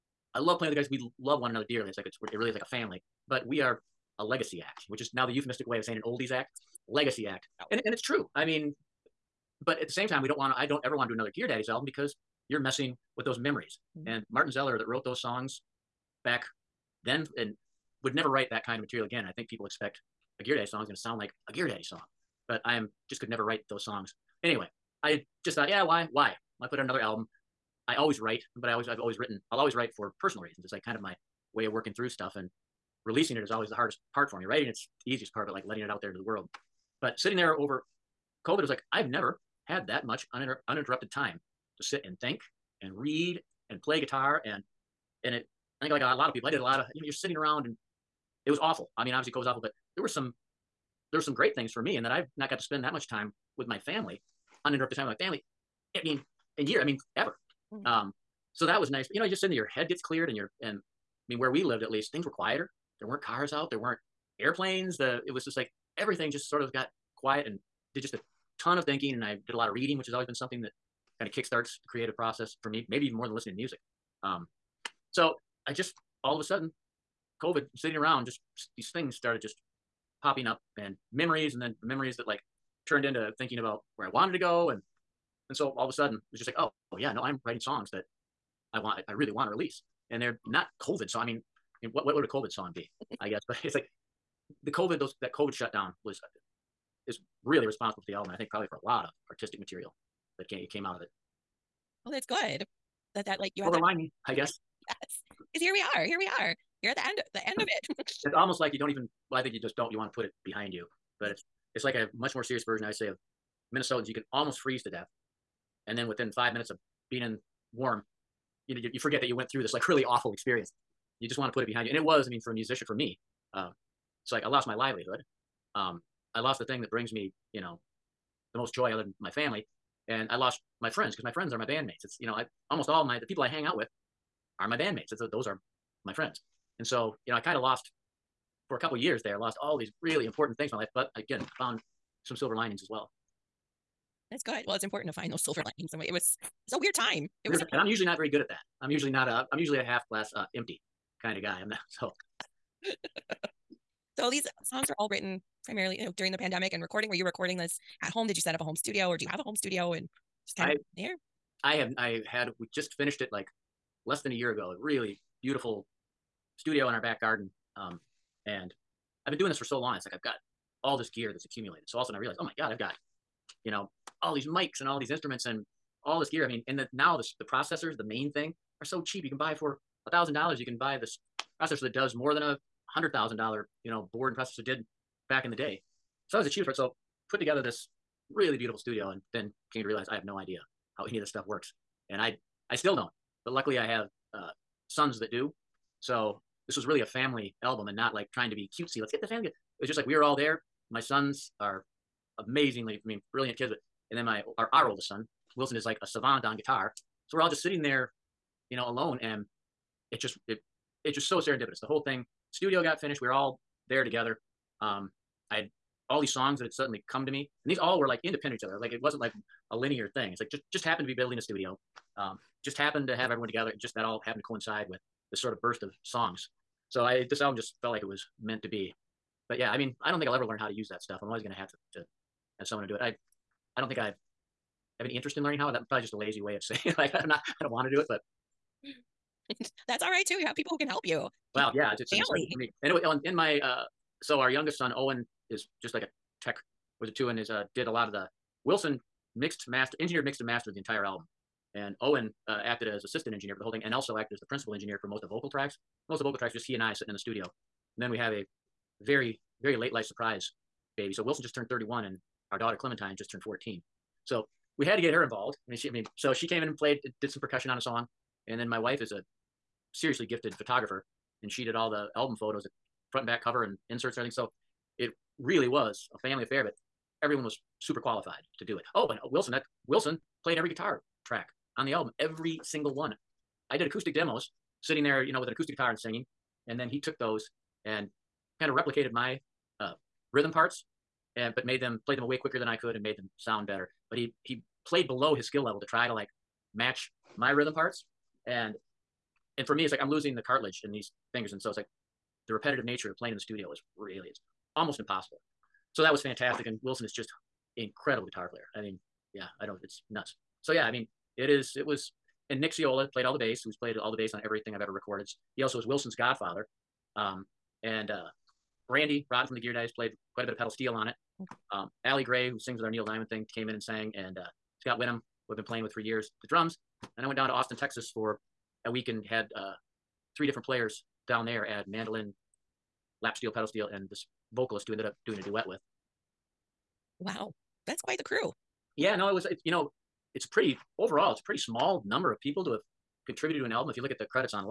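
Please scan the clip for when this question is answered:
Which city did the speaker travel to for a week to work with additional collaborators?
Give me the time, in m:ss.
5:27.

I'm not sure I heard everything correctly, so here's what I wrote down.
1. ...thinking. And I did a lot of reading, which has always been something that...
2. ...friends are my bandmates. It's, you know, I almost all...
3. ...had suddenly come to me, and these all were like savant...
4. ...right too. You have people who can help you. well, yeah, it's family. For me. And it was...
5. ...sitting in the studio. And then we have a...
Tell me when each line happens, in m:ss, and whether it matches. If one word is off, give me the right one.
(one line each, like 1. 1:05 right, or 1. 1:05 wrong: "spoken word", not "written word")
1. 1:08 right
2. 2:11 right
3. 3:36 wrong: "independent", not "savant"
4. 4:00 right
5. 4:16 right.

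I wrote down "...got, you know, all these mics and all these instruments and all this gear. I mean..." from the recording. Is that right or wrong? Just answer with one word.
right.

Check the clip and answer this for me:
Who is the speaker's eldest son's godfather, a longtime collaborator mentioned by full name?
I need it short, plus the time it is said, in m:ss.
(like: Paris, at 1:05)
Nick Ciola, at 5:12.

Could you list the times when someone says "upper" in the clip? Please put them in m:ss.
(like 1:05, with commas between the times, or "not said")
not said.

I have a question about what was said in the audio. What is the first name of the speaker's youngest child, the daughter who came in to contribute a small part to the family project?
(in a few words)
Clementine.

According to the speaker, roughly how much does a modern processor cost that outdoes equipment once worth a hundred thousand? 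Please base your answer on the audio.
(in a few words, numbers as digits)
$1,000.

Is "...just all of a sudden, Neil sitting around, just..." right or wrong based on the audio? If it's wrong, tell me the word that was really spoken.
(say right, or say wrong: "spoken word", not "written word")
wrong: "COVID", not "Neil".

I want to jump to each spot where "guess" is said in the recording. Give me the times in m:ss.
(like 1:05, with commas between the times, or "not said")
1:33, 1:44.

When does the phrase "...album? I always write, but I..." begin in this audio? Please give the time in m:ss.
0:26.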